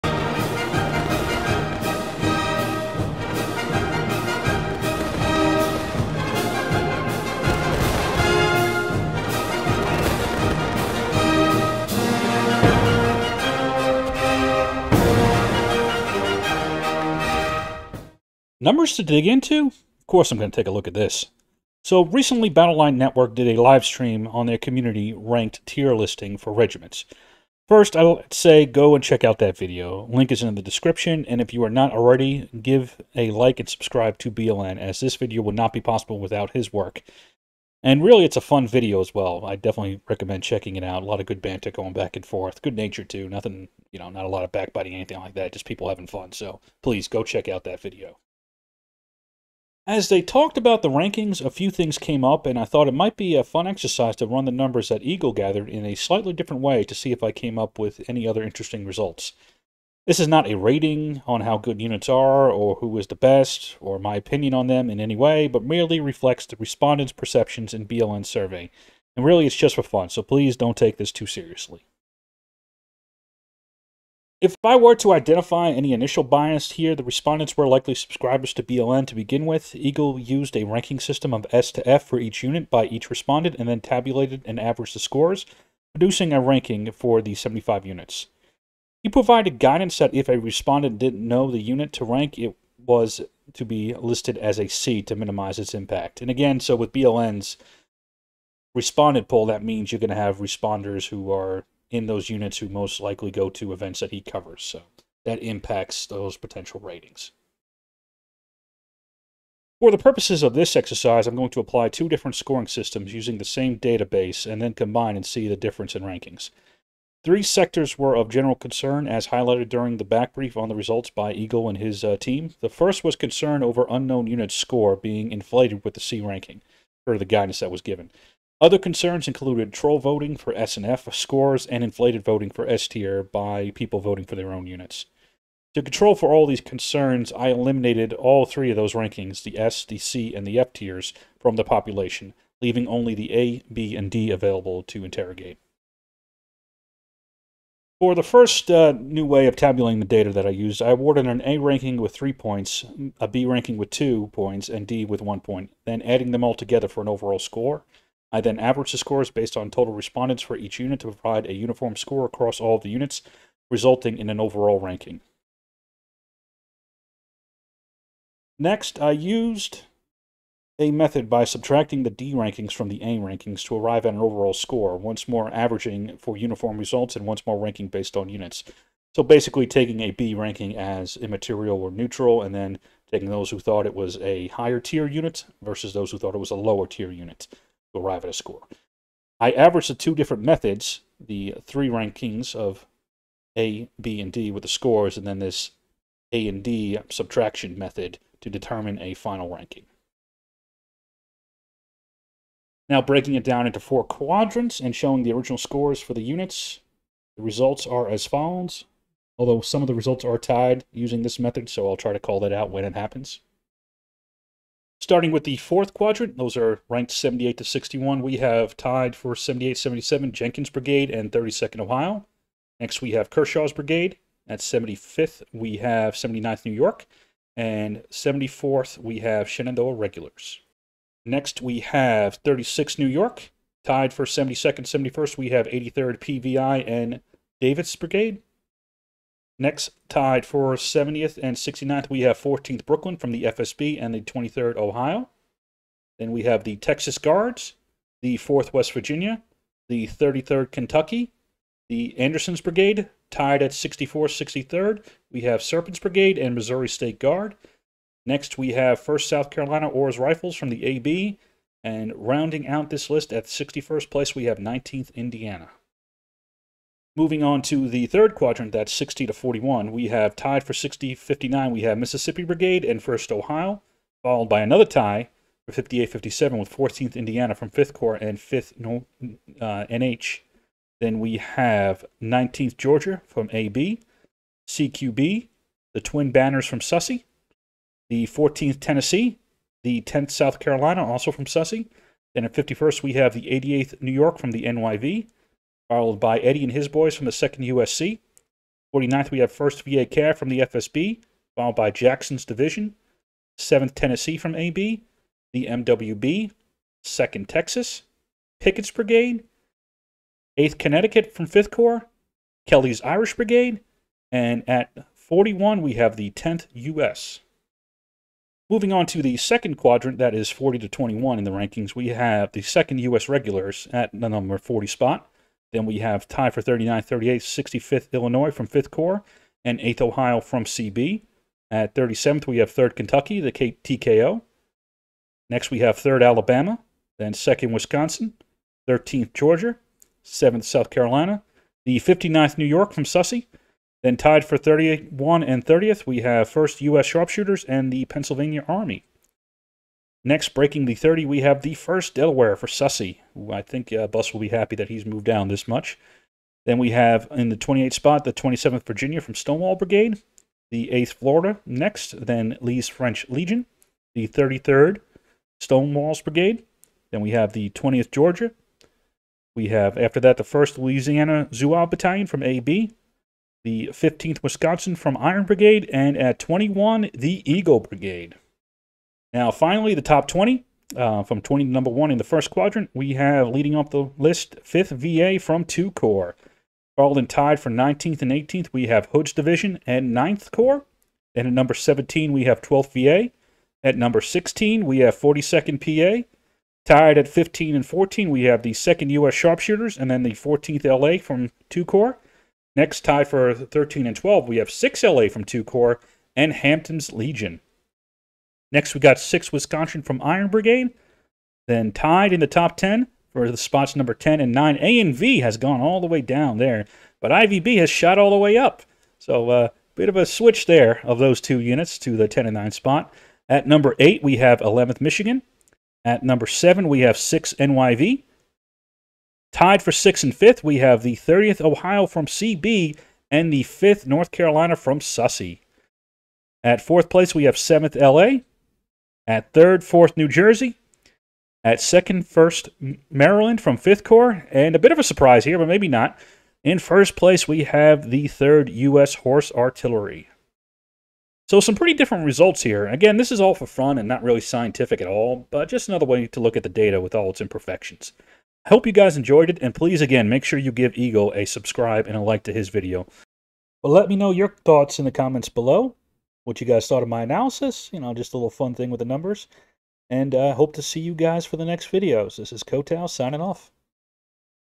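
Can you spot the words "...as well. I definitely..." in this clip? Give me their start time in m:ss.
0:39.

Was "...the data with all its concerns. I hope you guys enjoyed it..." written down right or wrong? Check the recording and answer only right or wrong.
wrong.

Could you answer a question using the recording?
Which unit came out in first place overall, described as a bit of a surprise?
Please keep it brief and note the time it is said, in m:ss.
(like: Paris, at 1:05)
3rd U.S. Horse Artillery, at 7:28.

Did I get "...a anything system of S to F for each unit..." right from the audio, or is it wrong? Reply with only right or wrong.
wrong.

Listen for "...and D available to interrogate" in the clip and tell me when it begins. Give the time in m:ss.
2:23.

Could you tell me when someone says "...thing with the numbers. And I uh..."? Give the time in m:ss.
7:48.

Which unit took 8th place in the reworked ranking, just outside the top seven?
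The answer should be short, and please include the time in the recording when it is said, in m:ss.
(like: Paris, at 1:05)
11th Michigan, at 7:04.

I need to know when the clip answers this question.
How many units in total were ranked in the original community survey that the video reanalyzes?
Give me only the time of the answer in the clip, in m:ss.
1:27.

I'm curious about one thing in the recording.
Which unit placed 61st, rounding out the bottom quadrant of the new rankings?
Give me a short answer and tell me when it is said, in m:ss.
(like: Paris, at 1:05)
19th Indiana, at 4:24.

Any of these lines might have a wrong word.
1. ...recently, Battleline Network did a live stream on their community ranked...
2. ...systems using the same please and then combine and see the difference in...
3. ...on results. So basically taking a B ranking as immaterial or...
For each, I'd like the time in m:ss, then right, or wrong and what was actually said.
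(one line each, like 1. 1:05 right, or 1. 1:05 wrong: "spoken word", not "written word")
1. 0:22 right
2. 1:52 wrong: "database", not "please"
3. 2:58 wrong: "units", not "results".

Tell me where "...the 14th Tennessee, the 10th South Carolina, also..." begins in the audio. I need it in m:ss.
4:48.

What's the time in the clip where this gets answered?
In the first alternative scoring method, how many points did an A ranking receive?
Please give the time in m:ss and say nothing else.
2:32.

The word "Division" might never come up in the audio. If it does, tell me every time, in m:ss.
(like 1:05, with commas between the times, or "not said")
5:02, 6:29.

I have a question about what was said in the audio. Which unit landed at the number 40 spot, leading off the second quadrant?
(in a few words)
2nd U.S. Regulars.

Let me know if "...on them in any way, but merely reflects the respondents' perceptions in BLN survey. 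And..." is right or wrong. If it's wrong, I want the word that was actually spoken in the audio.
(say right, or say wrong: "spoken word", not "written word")
right.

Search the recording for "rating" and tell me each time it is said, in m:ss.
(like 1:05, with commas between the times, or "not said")
1:00, 1:46.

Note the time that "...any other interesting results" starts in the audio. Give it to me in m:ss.
0:58.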